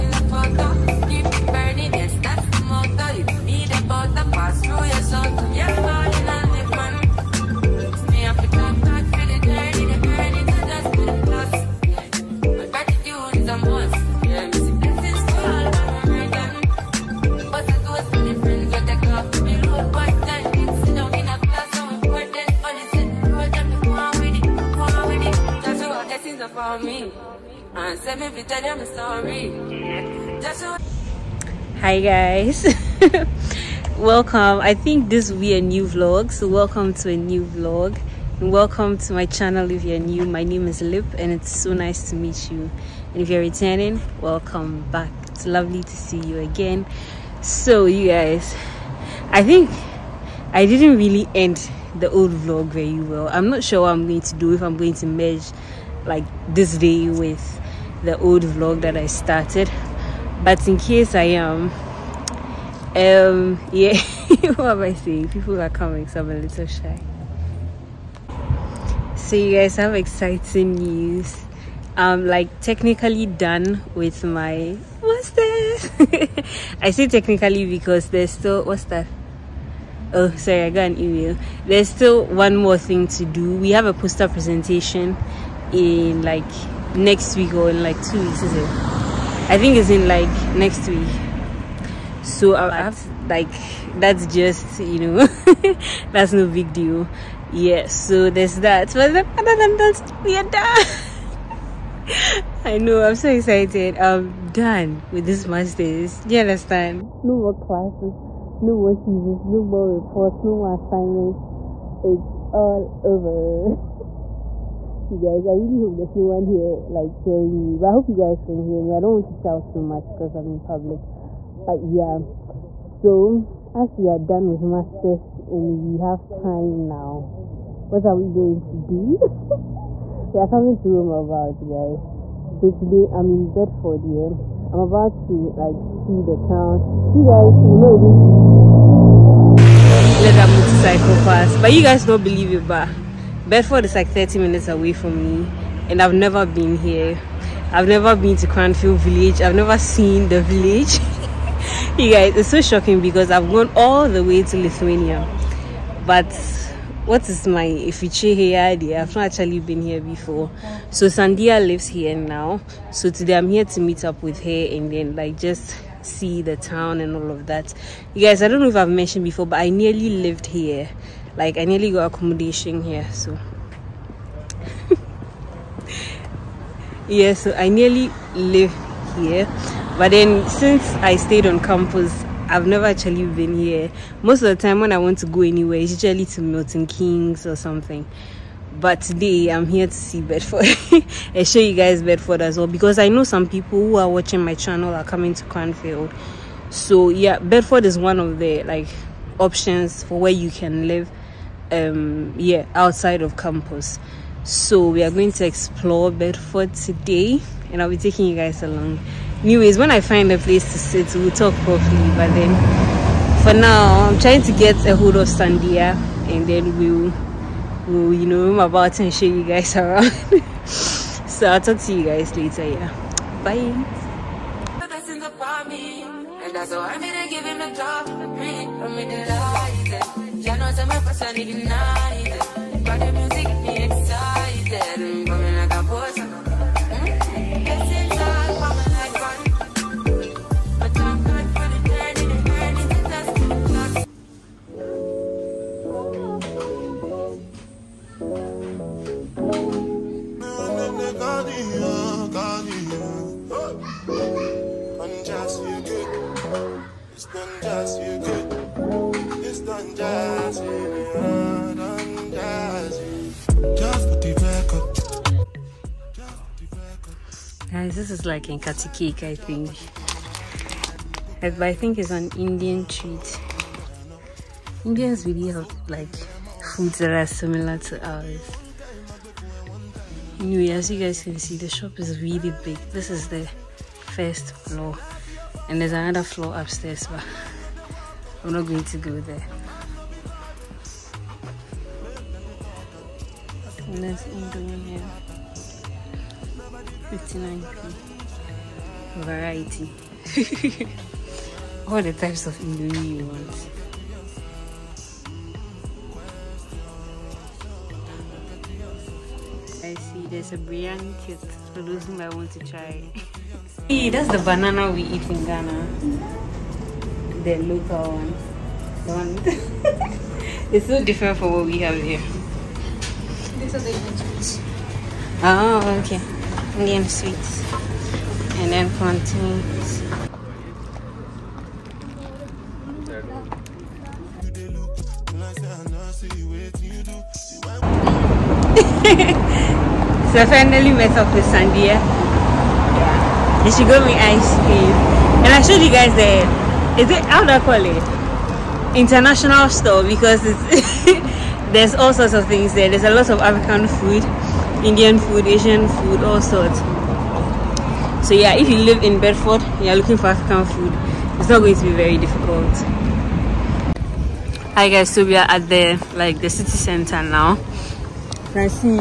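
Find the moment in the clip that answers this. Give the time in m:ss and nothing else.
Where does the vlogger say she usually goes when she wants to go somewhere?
3:06.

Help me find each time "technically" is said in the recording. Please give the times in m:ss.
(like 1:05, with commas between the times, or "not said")
1:12, 1:17.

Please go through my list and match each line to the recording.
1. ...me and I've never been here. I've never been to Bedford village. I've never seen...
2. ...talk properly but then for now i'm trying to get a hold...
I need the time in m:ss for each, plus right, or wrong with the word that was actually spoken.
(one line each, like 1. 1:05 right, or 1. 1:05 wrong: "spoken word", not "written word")
1. 2:25 wrong: "Cranfield", not "Bedford"
2. 3:31 right.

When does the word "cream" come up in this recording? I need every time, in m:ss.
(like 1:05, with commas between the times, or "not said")
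5:44.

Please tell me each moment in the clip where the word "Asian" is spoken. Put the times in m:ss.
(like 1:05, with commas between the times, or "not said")
5:55.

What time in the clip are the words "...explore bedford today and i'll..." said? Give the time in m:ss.
3:25.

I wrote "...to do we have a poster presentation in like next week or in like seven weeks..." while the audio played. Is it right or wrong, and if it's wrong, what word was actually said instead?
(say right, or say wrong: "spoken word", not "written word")
wrong: "two", not "seven".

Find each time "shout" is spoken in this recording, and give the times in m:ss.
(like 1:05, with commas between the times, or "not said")
1:59.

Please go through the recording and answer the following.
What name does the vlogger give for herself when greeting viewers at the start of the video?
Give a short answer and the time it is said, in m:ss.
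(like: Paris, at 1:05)
Lip, at 0:40.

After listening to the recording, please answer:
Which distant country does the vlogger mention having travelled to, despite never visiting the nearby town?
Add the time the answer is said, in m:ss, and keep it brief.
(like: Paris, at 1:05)
Lithuania, at 2:34.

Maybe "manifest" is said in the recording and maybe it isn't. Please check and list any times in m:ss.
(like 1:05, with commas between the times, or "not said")
not said.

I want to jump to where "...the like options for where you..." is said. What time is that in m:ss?
3:18.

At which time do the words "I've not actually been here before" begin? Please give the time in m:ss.
2:39.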